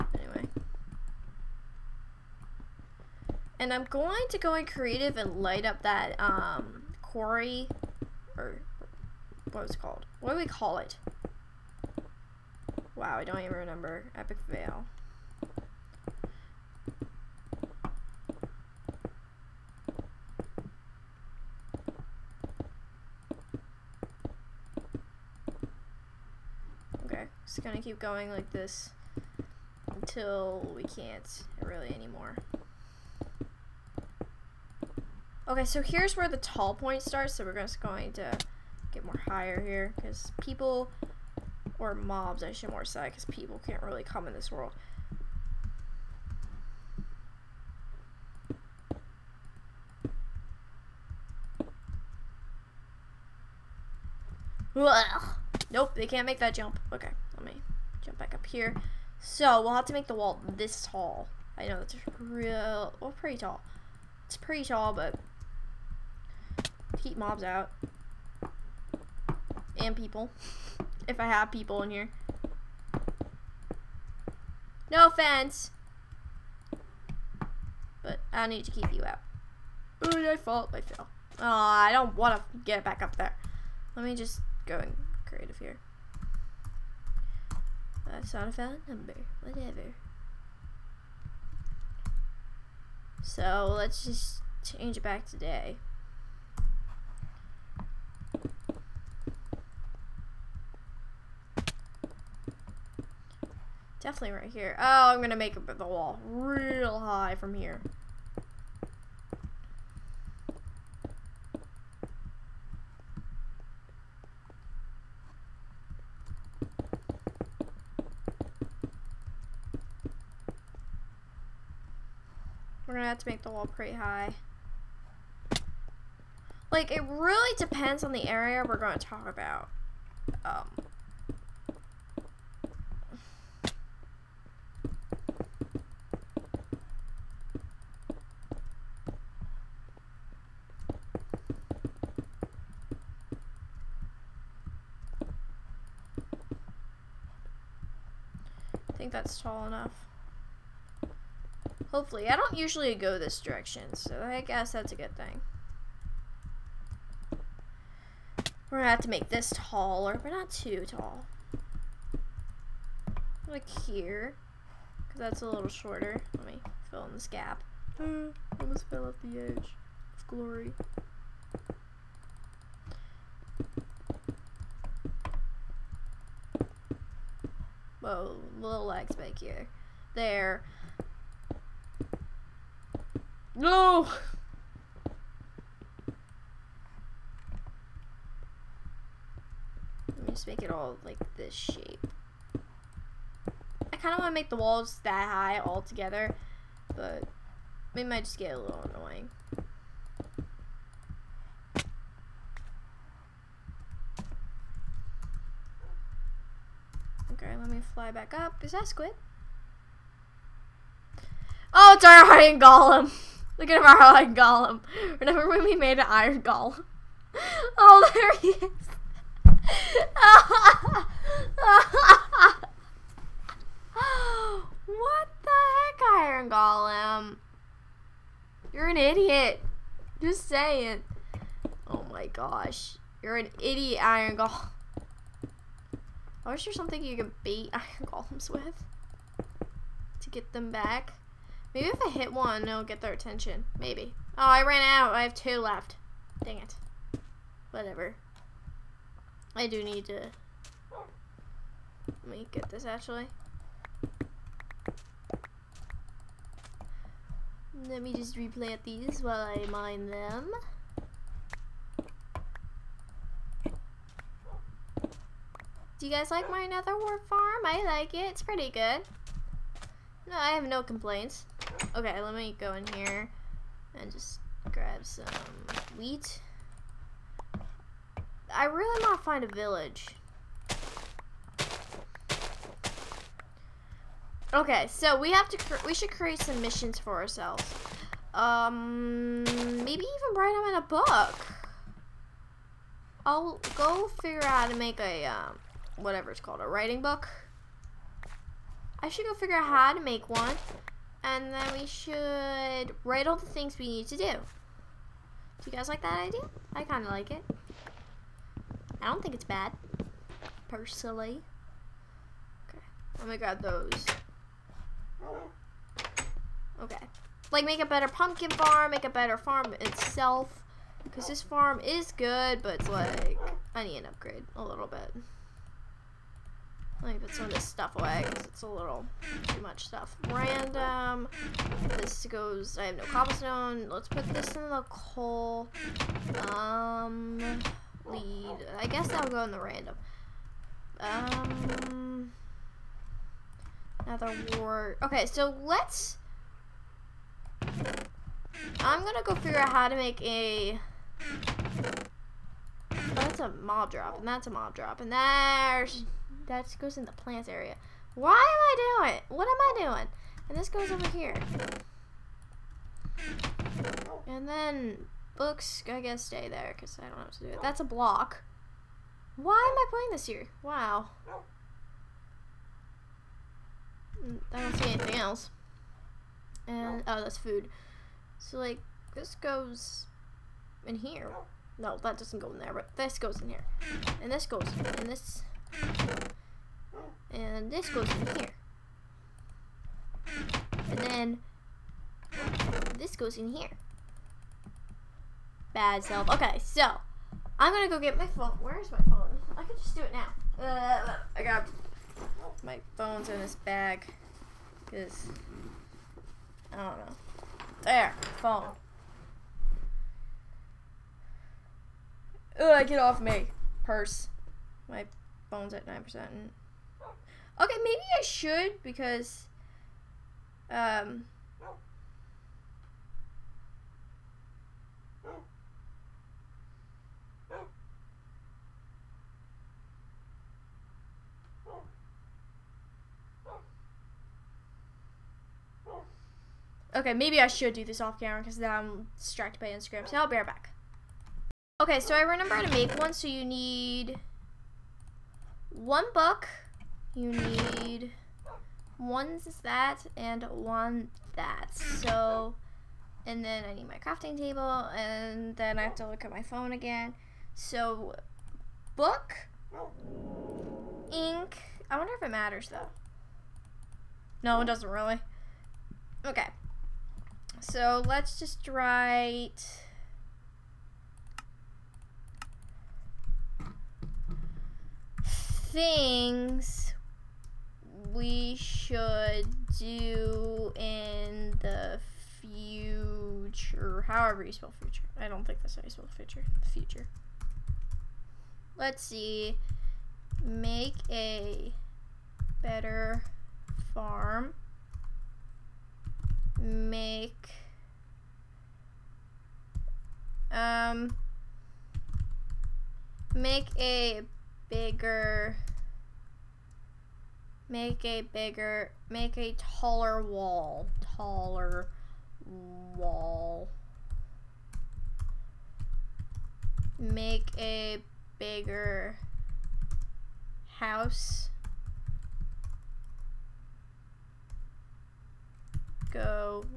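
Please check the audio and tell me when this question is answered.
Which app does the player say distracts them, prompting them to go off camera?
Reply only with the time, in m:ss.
7:19.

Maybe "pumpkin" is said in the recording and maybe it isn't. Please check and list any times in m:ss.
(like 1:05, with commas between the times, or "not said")
5:18.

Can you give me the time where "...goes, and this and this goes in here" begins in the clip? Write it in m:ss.
6:24.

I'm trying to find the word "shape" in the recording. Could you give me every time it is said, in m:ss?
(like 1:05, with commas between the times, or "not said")
3:11.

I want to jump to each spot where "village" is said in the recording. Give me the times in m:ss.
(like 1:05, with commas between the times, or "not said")
4:39.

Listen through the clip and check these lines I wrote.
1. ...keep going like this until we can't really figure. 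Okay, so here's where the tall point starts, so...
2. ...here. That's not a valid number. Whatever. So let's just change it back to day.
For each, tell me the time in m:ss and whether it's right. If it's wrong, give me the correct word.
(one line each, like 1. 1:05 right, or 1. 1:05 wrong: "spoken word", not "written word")
1. 0:27 wrong: "anymore", not "figure"
2. 1:25 right.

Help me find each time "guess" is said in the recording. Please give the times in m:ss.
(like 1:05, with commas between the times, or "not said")
2:34, 5:38, 6:06.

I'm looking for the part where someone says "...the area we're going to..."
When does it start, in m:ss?
2:08.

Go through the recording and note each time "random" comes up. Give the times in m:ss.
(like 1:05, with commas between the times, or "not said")
5:30, 5:39.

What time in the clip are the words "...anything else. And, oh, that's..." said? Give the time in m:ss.
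6:14.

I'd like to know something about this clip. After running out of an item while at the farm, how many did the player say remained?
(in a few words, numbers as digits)
2.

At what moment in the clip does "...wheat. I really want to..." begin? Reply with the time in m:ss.
4:35.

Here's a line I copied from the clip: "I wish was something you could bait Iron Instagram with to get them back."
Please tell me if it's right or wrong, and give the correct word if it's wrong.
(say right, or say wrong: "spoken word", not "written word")
wrong: "Golems", not "Instagram".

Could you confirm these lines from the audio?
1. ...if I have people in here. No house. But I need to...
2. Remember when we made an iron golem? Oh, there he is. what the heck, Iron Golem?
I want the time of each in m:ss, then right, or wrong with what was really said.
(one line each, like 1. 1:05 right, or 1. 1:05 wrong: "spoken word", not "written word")
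1. 1:11 wrong: "offense", not "house"
2. 3:35 right.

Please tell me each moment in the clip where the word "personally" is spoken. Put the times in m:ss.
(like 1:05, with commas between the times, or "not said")
5:10.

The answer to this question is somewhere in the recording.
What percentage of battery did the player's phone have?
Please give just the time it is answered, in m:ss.
6:55.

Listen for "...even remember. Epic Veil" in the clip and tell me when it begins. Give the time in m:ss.
0:13.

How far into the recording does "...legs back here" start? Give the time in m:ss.
2:58.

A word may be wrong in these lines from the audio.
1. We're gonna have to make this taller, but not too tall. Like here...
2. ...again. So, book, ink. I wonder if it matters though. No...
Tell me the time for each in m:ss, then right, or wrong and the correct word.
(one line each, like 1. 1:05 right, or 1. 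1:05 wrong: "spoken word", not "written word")
1. 2:38 right
2. 7:36 right.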